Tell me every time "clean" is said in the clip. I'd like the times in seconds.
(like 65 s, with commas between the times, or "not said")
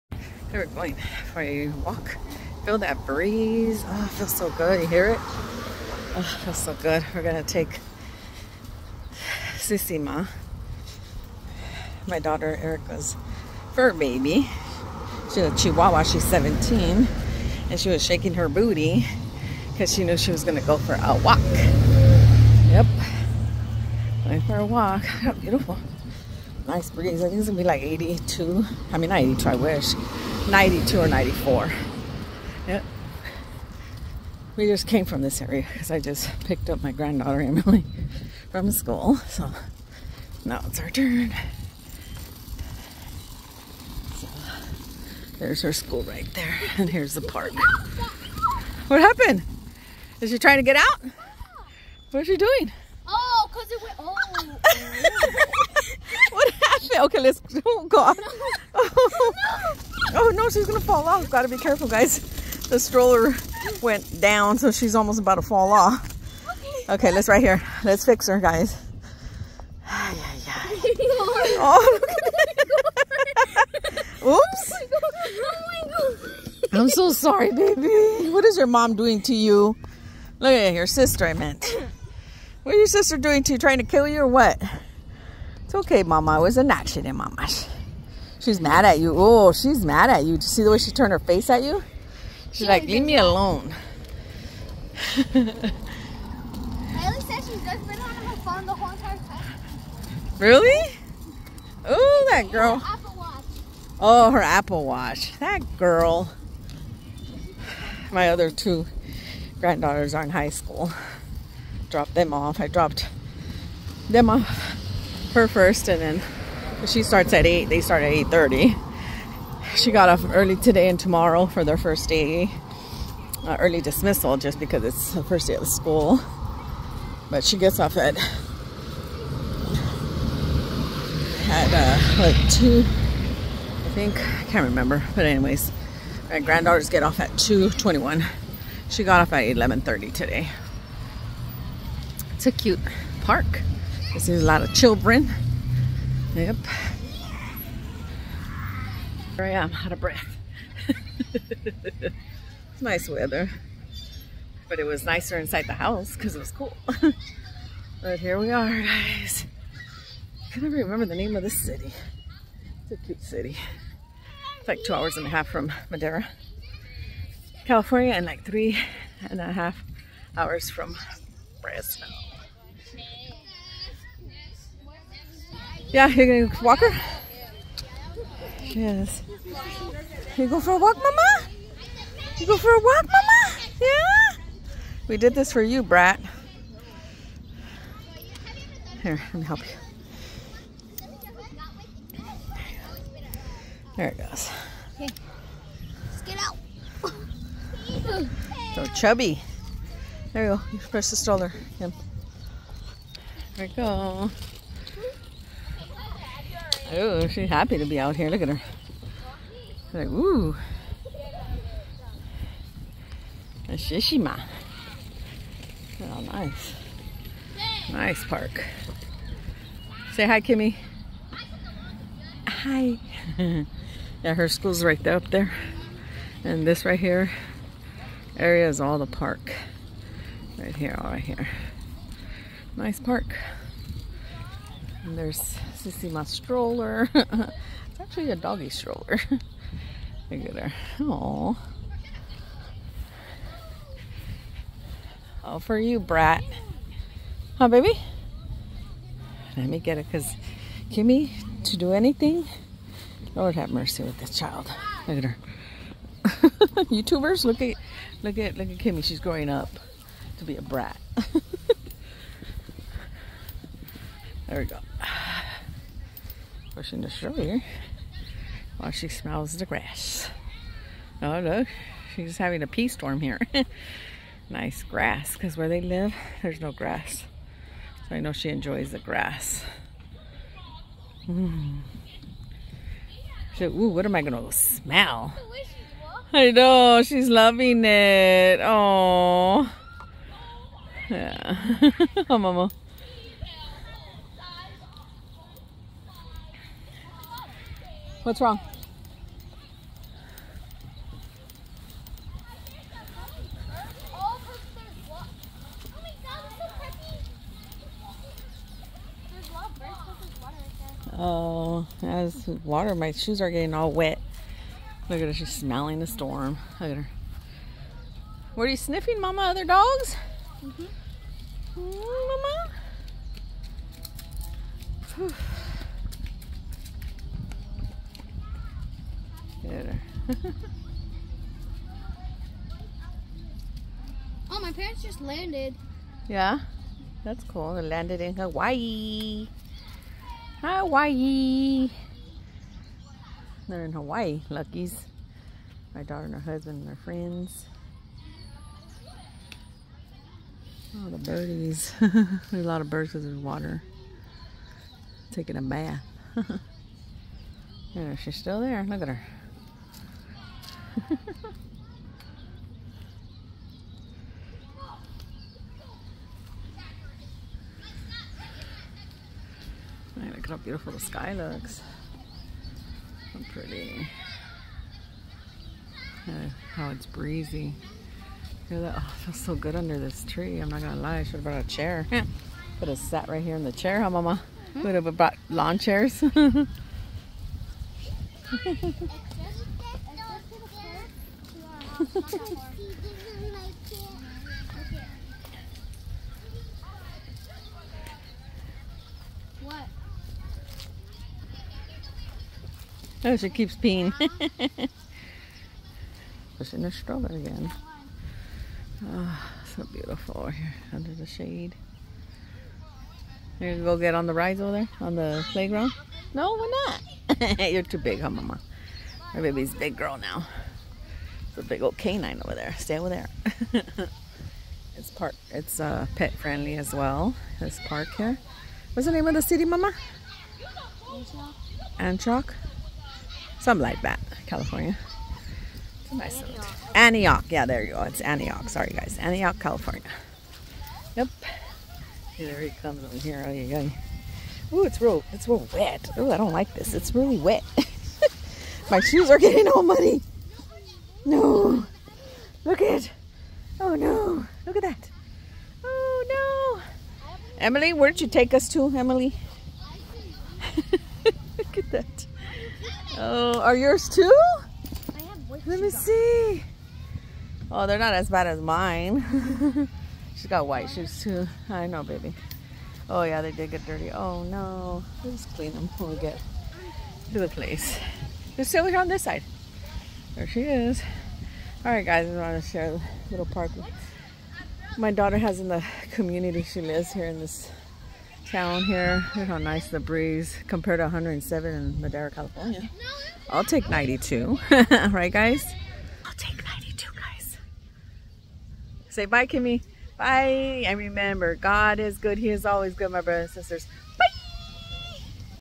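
475 s.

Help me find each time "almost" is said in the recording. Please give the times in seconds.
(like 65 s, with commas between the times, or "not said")
64 s.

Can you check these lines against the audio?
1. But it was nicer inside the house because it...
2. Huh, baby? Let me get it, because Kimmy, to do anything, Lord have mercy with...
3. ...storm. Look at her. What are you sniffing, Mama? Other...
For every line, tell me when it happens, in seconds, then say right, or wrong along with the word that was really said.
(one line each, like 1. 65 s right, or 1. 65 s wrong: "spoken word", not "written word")
1. 154 s right
2. 247 s right
3. 316 s right.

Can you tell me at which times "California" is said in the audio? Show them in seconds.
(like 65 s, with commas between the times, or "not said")
167 s, 434 s, 439 s, 492 s.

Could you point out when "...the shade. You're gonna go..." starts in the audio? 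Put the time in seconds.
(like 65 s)
411 s.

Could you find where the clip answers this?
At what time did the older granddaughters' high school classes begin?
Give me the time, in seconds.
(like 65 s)
118 s.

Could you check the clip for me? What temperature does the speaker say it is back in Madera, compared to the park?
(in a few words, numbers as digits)
107.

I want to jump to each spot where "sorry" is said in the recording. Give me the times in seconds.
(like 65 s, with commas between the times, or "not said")
77 s, 438 s.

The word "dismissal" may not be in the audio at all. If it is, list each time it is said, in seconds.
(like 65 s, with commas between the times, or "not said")
123 s.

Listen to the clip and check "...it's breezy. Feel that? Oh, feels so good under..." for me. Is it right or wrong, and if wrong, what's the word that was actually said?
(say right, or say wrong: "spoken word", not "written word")
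right.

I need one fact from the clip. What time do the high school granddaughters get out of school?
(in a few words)
2:21.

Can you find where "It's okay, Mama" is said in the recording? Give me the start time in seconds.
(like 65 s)
85 s.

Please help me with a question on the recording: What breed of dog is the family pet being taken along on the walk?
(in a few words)
Chihuahua.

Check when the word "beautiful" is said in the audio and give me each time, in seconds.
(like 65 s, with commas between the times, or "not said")
25 s, 370 s, 409 s.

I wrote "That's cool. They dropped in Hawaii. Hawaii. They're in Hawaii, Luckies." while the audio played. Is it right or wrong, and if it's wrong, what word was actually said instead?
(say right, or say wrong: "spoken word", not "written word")
wrong: "landed", not "dropped".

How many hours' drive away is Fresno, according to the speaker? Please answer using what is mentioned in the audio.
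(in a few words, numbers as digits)
3 and a half hours.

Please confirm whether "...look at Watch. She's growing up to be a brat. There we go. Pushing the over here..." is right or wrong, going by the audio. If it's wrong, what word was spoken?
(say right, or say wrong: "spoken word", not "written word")
wrong: "Kimmy", not "Watch".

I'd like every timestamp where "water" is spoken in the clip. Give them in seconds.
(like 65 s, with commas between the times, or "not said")
312 s, 353 s.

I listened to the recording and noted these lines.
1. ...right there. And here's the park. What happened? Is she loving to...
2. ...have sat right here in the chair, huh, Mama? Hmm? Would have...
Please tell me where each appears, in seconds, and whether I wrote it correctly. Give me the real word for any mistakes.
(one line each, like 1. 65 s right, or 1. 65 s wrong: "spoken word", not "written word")
1. 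46 s wrong: "trying", not "loving"
2. 382 s right.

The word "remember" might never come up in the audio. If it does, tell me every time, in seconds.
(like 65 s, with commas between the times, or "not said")
134 s, 160 s, 500 s.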